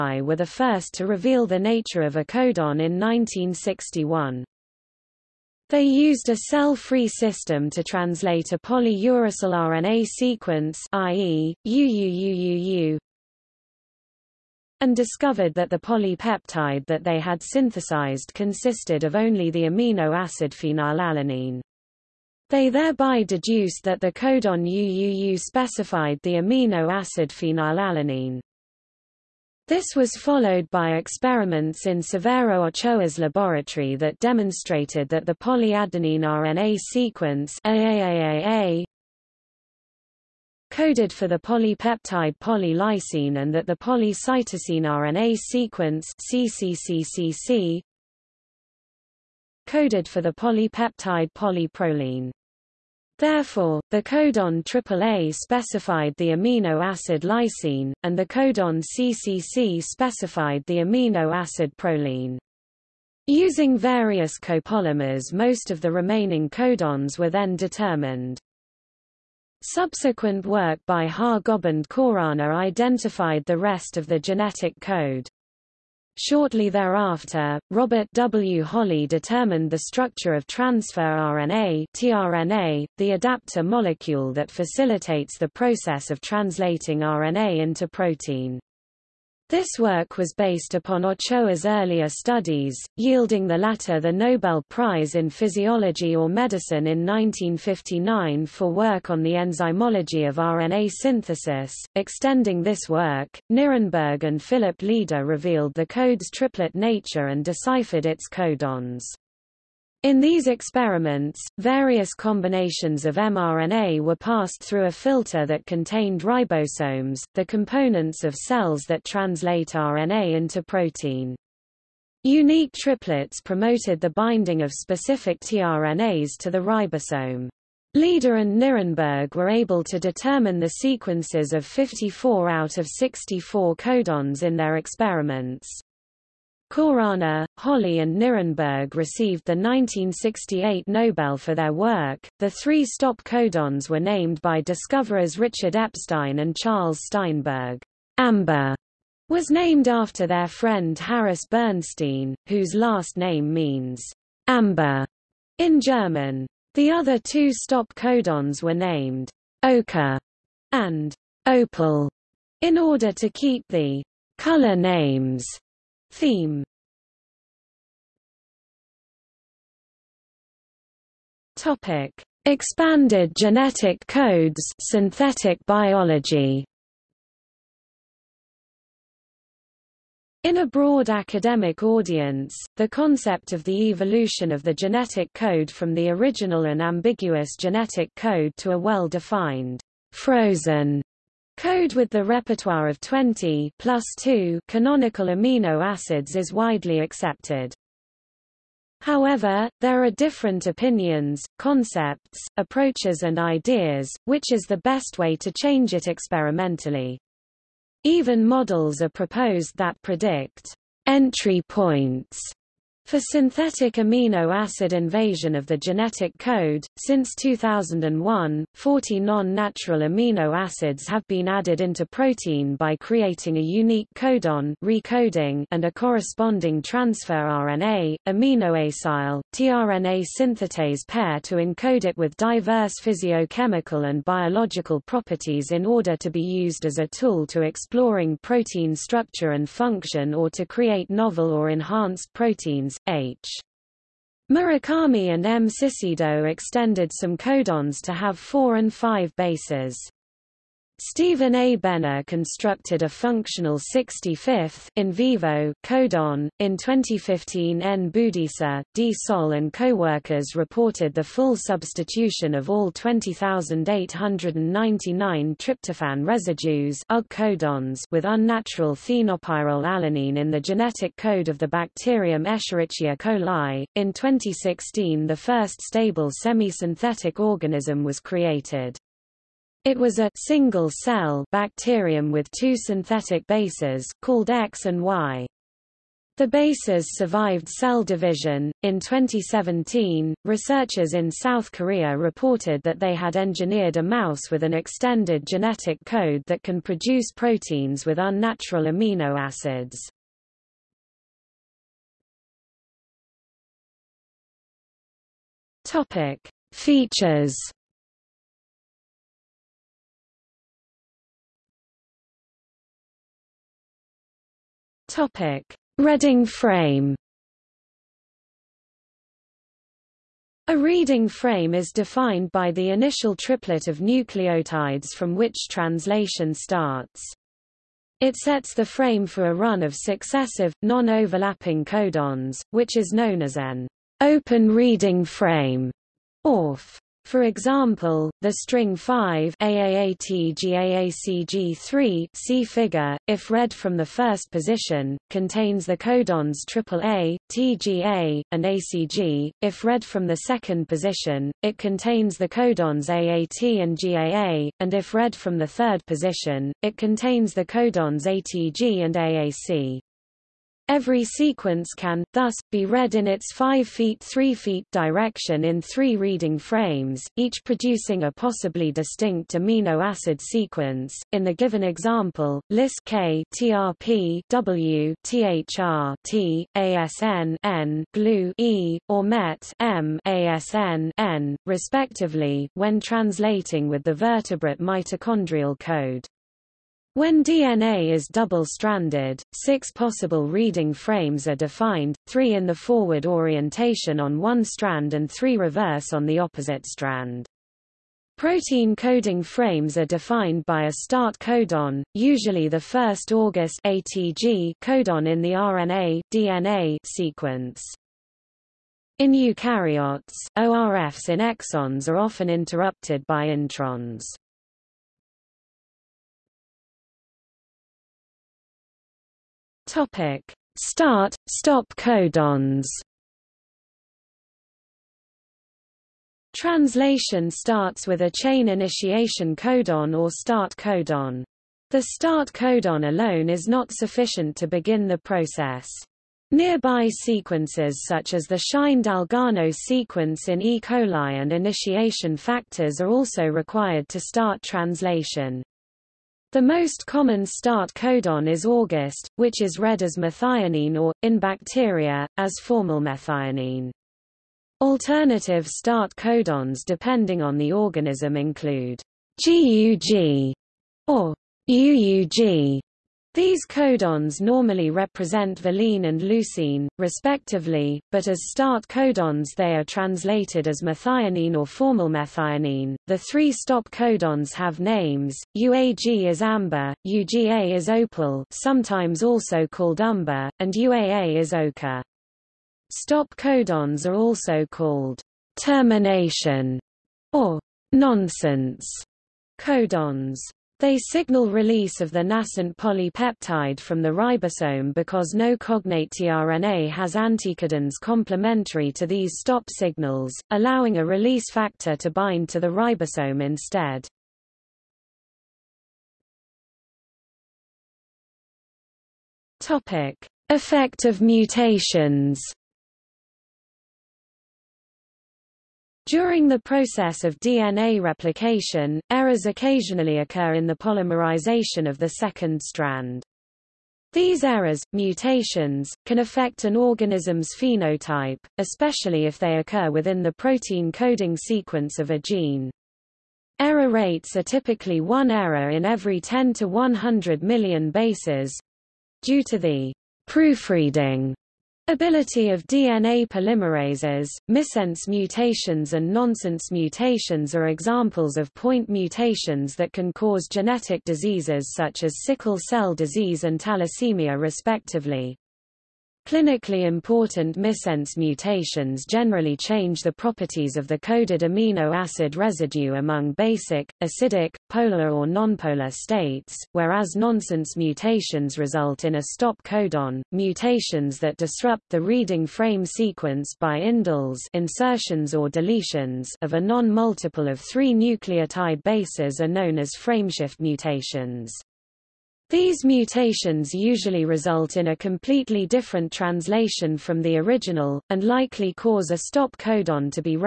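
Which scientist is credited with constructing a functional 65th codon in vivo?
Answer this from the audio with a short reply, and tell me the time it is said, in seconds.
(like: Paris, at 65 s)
Stephen A. Benner, at 251 s.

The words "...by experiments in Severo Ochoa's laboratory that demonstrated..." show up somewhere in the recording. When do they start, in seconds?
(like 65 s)
30 s.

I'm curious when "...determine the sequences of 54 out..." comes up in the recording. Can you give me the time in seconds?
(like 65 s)
129 s.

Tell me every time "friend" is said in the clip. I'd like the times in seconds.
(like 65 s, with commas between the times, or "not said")
150 s.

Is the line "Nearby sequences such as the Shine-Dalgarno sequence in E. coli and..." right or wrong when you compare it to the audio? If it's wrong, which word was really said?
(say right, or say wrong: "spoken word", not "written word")
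right.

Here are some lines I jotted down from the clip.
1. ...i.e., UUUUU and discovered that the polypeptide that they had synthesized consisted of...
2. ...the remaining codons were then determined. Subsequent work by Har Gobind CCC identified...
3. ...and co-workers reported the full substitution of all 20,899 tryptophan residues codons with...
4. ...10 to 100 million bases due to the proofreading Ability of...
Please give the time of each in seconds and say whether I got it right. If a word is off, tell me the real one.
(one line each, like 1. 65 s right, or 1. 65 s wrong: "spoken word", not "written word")
1. 10 s right
2. 65 s wrong: "Khorana", not "CCC"
3. 259 s right
4. 536 s right.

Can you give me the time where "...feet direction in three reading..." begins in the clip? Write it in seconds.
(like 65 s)
364 s.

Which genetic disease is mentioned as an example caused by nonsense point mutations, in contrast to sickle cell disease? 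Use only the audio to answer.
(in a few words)
thalassemia.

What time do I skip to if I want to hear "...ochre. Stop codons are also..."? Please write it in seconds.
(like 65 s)
481 s.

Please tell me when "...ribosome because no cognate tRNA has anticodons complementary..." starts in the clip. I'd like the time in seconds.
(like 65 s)
494 s.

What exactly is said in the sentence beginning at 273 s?
In 2016 the first stable semi-synthetic organism was created.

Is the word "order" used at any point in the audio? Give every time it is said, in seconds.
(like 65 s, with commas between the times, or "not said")
162 s, 235 s.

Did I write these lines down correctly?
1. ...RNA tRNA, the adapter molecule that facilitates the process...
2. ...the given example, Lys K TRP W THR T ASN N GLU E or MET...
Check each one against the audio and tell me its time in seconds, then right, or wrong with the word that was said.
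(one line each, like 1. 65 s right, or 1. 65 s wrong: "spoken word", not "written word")
1. 80 s right
2. 371 s right.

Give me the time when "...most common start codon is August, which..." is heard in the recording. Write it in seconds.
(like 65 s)
446 s.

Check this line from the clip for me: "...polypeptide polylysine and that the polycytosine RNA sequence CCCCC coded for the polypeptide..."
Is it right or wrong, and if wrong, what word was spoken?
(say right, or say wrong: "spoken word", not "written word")
right.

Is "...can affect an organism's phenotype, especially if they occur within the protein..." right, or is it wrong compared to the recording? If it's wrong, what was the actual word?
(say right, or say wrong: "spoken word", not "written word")
right.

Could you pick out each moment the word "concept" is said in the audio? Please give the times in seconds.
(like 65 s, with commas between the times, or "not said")
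182 s, 201 s.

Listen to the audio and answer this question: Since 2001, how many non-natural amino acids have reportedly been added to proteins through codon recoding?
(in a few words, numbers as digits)
40.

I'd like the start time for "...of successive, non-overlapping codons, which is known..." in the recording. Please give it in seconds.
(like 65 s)
329 s.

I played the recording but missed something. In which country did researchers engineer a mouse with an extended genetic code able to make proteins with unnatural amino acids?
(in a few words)
South Korea.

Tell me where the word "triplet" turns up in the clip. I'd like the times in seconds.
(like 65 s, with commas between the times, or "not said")
106 s, 122 s, 323 s.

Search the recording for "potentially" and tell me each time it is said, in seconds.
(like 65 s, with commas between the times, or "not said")
not said.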